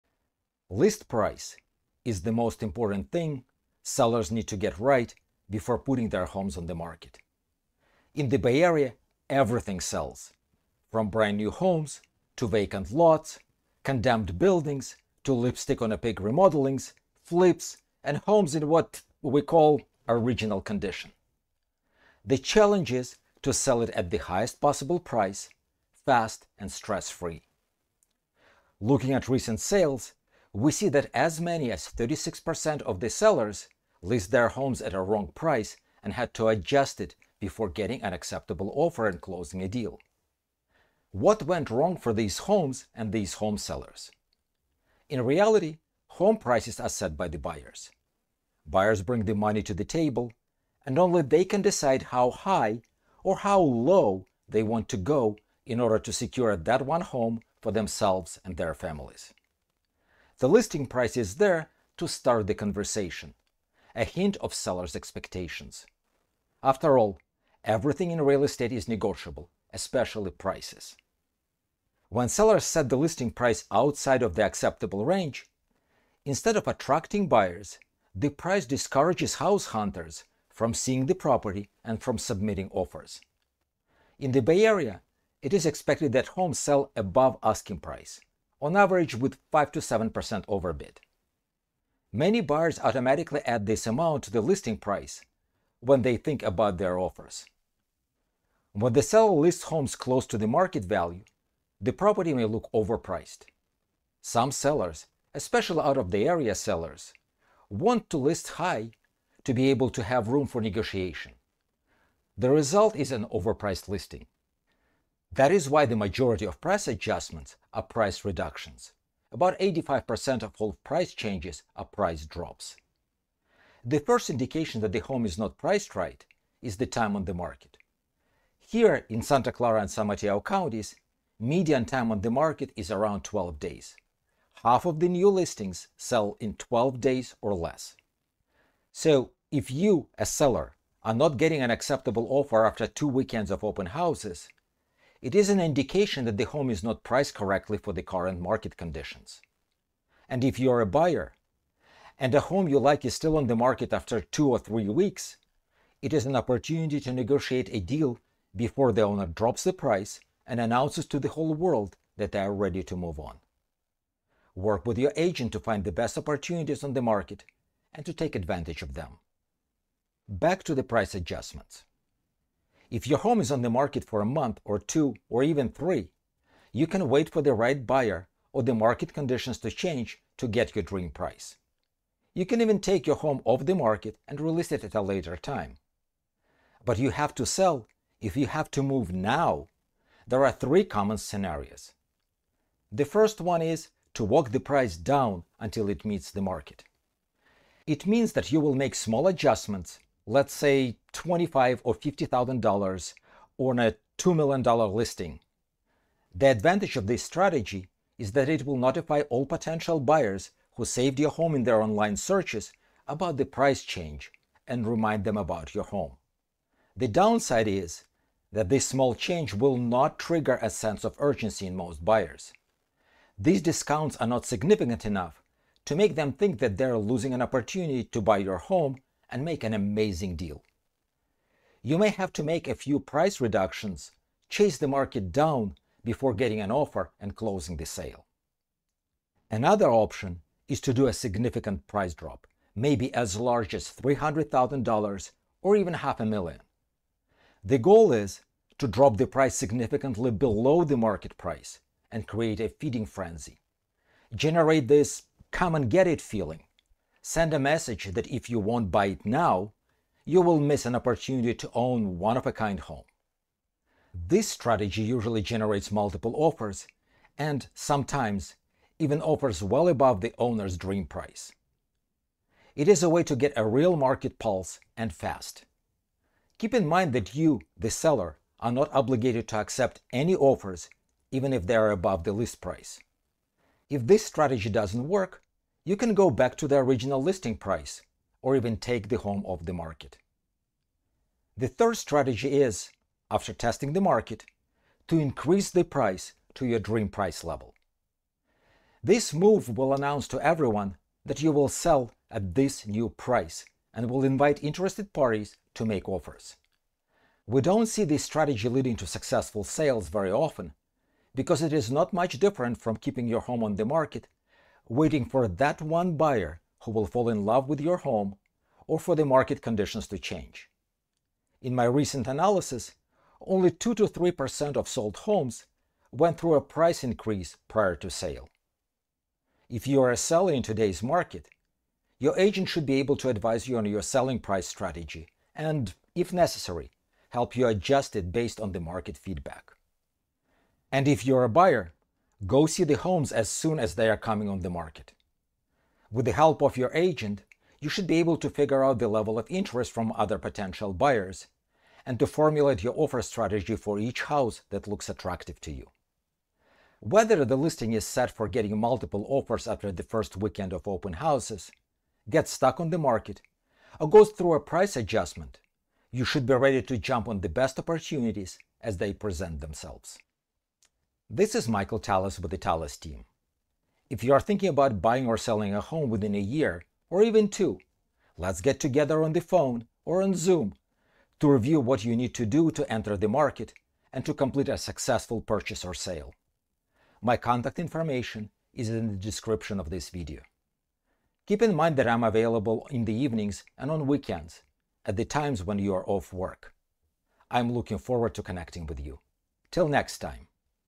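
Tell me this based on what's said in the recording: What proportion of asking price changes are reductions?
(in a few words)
85%.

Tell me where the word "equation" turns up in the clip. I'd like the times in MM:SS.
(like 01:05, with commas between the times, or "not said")
not said.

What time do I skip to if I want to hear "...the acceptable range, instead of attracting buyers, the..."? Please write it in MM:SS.
01:14.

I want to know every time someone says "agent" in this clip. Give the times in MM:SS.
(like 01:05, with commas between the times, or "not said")
02:45, 05:32, 05:46.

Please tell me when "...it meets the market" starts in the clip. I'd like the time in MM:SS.
03:15.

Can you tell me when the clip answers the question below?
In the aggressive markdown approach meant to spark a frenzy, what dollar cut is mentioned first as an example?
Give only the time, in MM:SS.
04:03.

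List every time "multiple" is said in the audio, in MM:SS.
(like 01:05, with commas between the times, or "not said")
04:25, 05:58.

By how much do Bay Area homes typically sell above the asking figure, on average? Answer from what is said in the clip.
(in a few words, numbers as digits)
5 to 7%.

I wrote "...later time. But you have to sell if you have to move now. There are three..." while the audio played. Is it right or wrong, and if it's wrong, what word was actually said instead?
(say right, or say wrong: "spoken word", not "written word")
right.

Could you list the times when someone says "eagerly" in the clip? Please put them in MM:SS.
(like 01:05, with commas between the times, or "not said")
not said.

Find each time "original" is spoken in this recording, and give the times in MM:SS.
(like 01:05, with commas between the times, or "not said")
00:20, 04:46.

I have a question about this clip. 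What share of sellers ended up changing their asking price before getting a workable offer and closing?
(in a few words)
36%.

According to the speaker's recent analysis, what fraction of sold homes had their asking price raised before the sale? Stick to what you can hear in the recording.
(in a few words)
2 to 3%.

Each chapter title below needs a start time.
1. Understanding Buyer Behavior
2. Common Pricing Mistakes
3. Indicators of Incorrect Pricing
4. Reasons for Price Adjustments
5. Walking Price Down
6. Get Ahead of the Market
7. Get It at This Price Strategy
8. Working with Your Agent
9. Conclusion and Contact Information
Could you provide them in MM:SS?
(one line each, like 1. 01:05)
1. 00:45
2. 01:44
3. 02:03
4. 02:52
5. 03:13
6. 03:59
7. 04:51
8. 05:29
9. 06:10.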